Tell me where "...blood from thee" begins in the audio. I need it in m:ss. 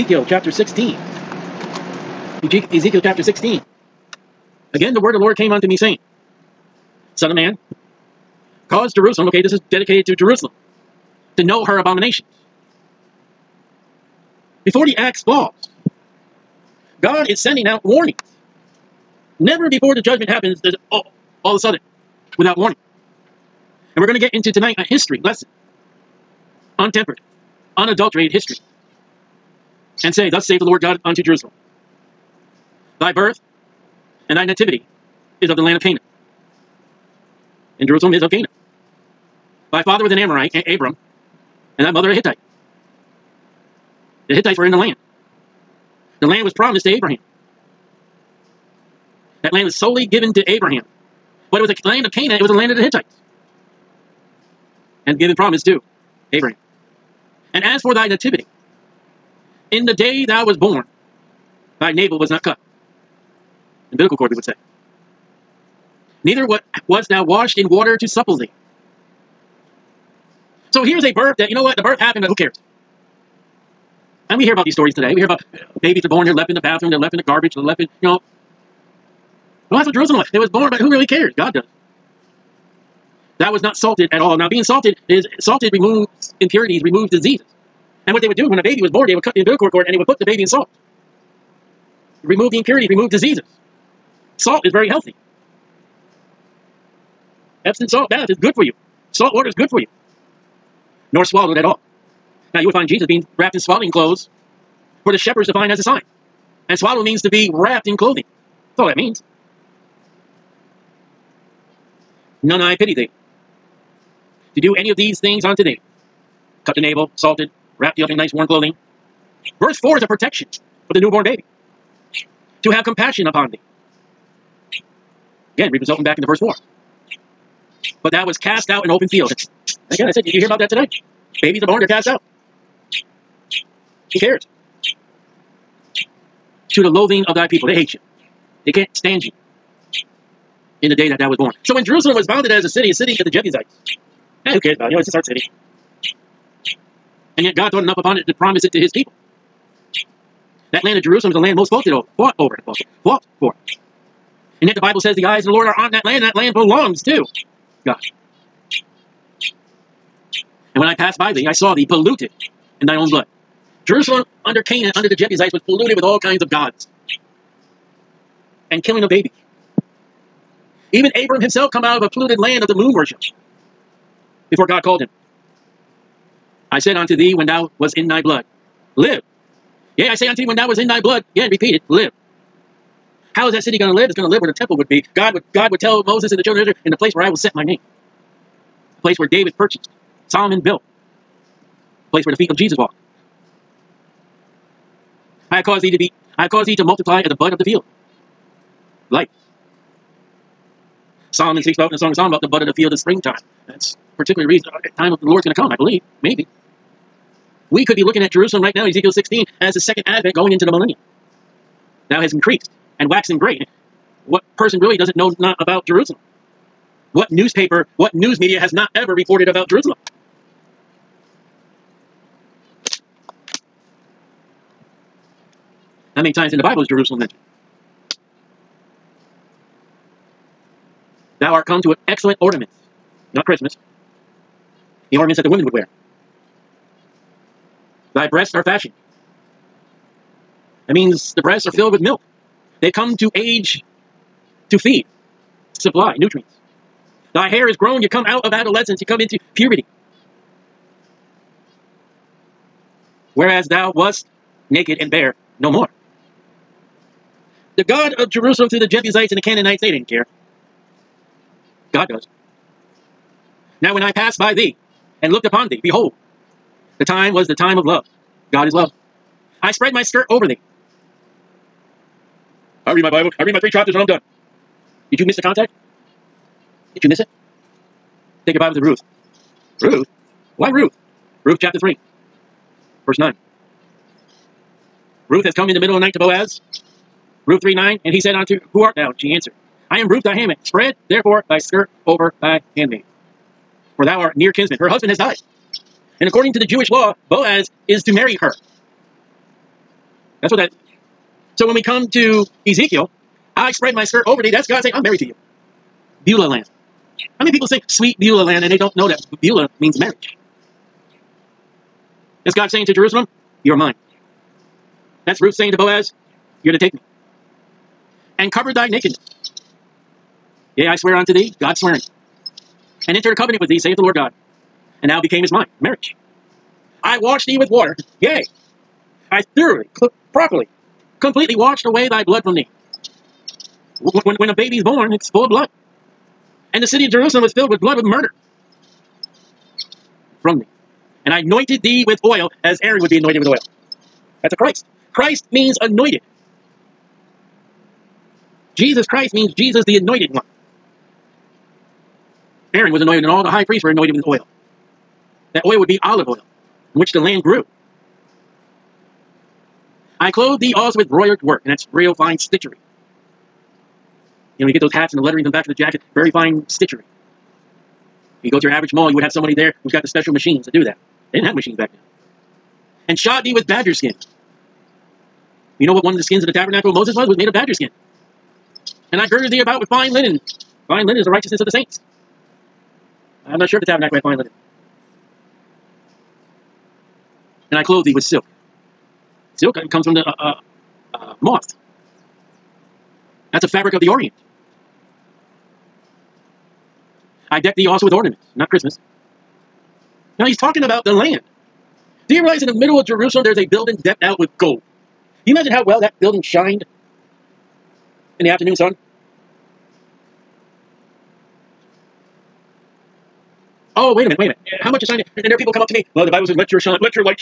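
5:32.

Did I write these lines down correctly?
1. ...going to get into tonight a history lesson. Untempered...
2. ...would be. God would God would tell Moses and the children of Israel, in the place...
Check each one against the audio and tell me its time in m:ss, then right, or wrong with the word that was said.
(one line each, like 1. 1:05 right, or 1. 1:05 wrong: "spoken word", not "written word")
1. 0:24 right
2. 3:04 right.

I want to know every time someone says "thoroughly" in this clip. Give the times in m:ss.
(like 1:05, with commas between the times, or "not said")
5:29.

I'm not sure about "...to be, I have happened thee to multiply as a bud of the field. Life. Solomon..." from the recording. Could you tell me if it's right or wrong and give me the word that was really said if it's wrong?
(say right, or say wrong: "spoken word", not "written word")
wrong: "caused", not "happened".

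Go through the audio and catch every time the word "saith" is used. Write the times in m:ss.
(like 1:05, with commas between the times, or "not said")
0:30, 5:23.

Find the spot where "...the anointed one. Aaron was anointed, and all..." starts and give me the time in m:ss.
5:49.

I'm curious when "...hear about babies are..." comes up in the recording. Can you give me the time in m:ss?
1:15.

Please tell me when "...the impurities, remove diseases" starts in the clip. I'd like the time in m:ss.
1:32.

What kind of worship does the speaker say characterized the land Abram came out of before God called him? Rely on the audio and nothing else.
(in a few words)
moon worship.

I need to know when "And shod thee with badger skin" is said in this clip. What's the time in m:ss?
6:13.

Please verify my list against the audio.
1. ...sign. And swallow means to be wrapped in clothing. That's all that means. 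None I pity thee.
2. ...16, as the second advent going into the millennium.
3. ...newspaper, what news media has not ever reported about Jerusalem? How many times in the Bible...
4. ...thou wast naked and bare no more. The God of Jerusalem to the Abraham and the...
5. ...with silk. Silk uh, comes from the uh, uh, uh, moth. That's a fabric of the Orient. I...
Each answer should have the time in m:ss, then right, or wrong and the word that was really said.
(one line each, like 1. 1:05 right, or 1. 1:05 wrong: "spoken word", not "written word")
1. 1:45 right
2. 3:29 right
3. 3:37 right
4. 4:13 wrong: "Jebusites", not "Abraham"
5. 6:28 right.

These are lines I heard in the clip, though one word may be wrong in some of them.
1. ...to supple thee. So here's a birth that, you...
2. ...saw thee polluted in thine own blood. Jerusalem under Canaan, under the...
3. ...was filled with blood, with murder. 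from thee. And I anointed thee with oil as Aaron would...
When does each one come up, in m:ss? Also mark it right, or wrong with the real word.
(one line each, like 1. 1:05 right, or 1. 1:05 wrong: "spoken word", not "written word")
1. 1:07 right
2. 2:41 right
3. 5:37 right.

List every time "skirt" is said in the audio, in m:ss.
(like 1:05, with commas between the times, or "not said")
4:30, 4:51, 5:04.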